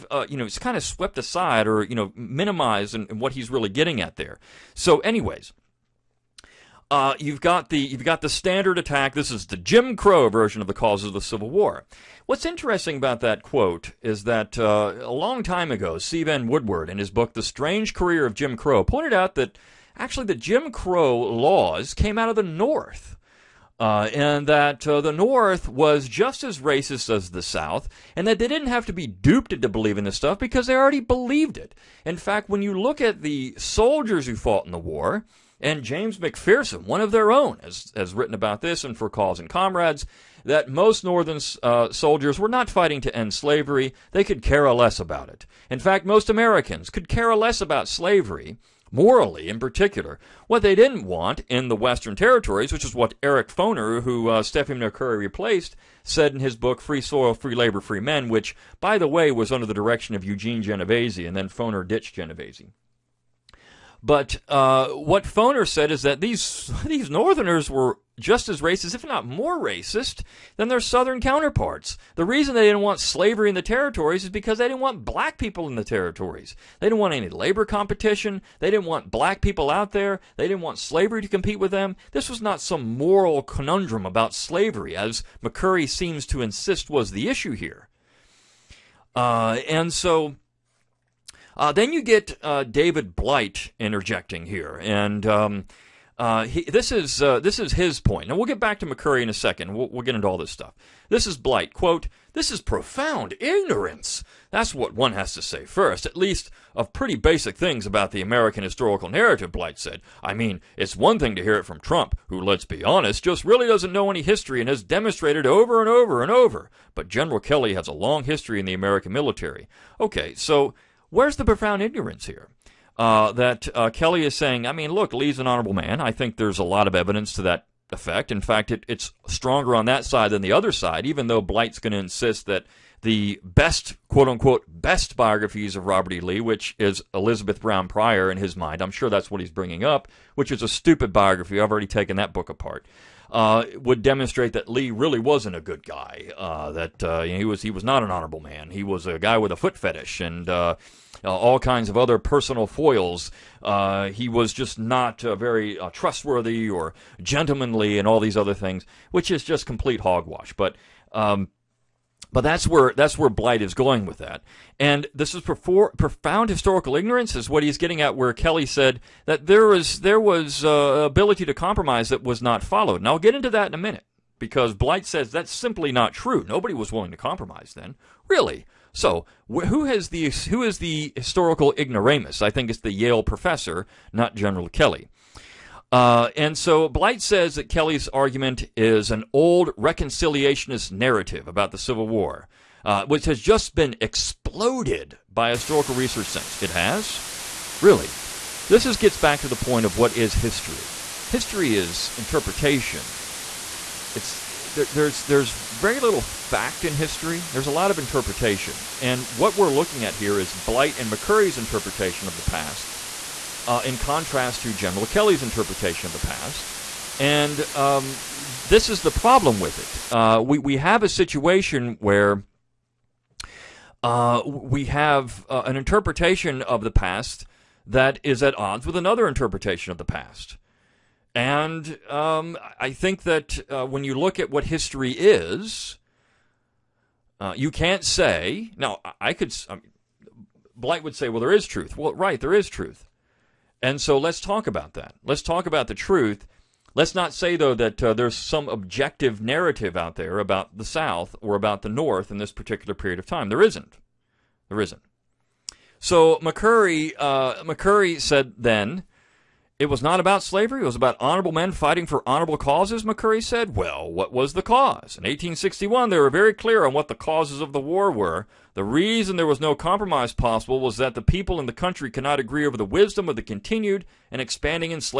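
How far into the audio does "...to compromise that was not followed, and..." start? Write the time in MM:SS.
02:51.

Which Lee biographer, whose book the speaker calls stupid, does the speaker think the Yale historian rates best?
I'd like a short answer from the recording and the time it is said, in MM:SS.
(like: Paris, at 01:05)
Elizabeth Brown Pryor, at 02:17.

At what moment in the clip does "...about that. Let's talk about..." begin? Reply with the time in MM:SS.
04:04.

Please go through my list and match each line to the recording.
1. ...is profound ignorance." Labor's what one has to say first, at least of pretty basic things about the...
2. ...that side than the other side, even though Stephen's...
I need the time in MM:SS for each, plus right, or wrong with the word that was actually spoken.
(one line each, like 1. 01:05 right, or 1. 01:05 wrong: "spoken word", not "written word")
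1. 01:42 wrong: "That", not "Labor"
2. 02:09 wrong: "Blight", not "Stephen".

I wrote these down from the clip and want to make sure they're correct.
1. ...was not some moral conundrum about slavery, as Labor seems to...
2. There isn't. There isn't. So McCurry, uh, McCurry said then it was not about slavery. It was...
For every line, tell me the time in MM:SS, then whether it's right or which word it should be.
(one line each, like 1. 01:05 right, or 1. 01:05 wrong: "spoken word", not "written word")
1. 01:22 wrong: "McCurry", not "Labor"
2. 04:13 right.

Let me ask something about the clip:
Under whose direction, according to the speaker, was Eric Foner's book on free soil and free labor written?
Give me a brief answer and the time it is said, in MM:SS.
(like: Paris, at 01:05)
Eugene Genovese, at 01:00.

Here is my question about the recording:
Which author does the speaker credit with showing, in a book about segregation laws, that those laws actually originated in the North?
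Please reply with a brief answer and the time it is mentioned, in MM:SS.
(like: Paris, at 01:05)
Stephen Woodward, at 00:15.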